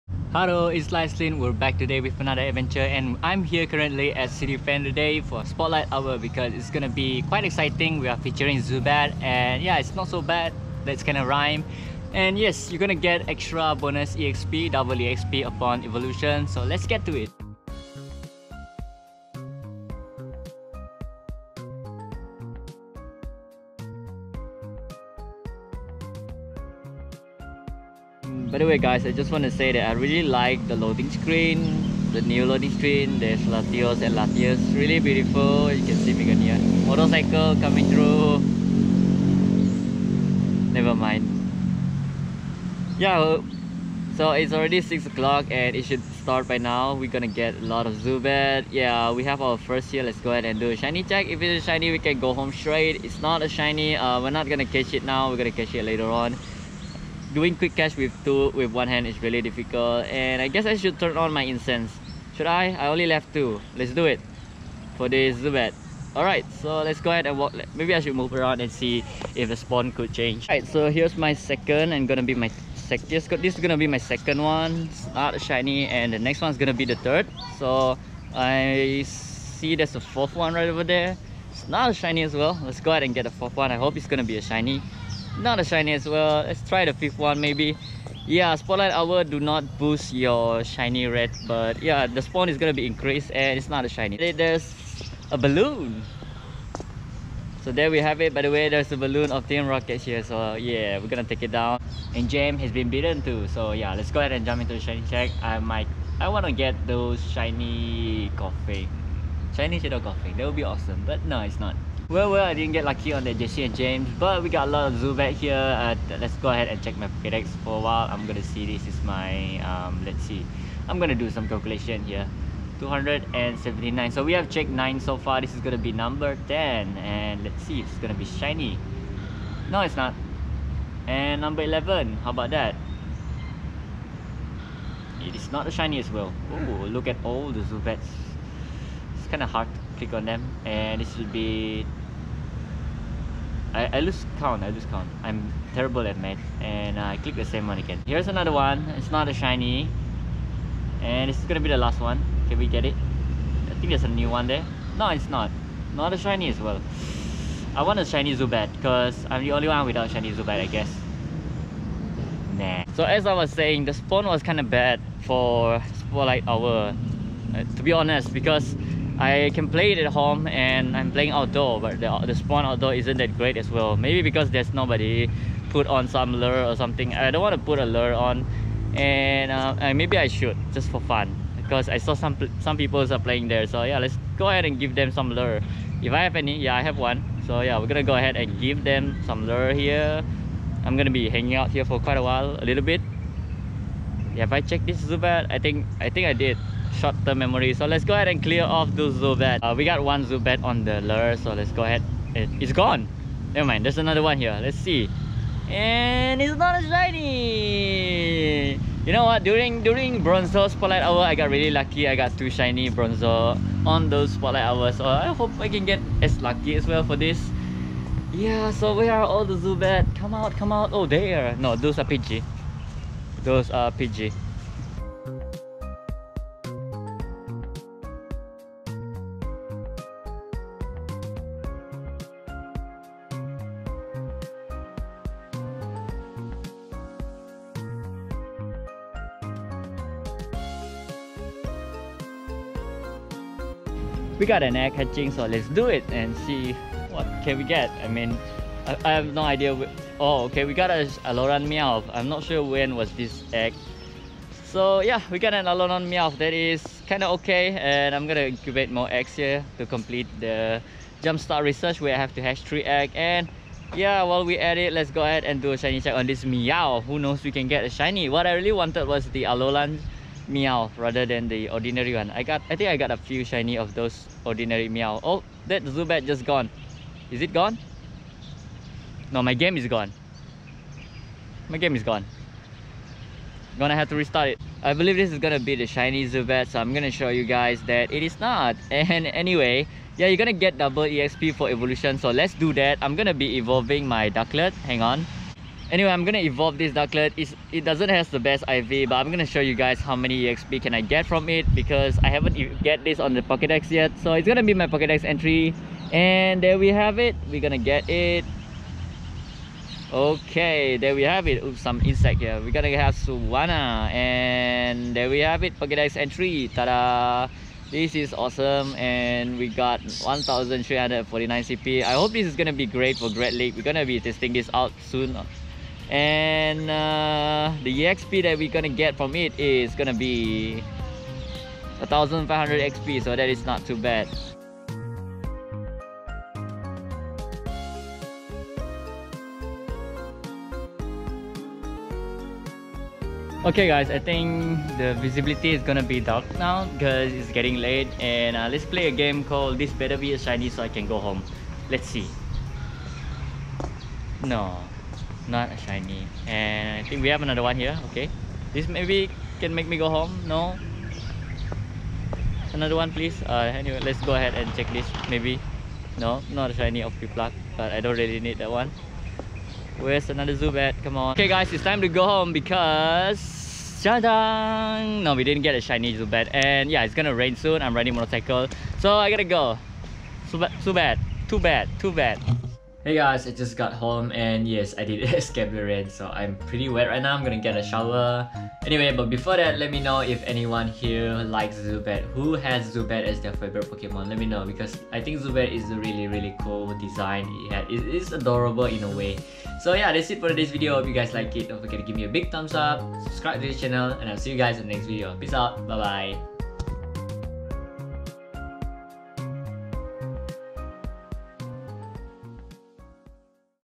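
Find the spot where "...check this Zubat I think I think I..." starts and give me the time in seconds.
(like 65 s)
194 s.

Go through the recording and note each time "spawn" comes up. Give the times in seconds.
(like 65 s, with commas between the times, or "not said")
69 s, 92 s, 163 s, 172 s.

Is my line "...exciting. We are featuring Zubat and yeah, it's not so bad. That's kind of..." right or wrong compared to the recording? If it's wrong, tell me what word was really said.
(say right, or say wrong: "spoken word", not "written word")
right.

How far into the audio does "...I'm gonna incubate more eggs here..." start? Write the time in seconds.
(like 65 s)
258 s.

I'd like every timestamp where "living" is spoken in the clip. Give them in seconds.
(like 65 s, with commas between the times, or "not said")
not said.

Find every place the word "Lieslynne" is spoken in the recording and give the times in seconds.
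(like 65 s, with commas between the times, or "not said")
0 s.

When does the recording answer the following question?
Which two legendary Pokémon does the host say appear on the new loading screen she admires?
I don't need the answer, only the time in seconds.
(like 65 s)
33 s.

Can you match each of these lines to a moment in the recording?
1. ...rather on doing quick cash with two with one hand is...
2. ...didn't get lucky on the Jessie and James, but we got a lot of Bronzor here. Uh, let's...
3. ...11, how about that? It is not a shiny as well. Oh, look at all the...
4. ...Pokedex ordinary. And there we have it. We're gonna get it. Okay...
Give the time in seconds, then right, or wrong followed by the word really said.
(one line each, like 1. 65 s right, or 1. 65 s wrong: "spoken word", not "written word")
1. 55 s wrong: "later", not "rather"
2. 112 s wrong: "Zubat", not "Bronzor"
3. 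131 s right
4. 304 s wrong: "entry", not "ordinary".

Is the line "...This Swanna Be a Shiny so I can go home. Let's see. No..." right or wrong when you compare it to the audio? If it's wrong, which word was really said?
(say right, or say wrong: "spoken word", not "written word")
wrong: "Better", not "Swanna".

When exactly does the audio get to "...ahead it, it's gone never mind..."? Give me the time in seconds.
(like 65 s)
201 s.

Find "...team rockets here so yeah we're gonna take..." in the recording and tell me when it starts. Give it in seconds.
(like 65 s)
99 s.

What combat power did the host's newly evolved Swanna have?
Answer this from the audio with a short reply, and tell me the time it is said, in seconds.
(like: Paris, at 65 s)
1349, at 319 s.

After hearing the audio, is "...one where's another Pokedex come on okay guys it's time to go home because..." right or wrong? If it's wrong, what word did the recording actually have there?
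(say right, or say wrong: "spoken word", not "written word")
wrong: "Zubat", not "Pokedex".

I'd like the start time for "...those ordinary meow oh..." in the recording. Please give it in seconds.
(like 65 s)
273 s.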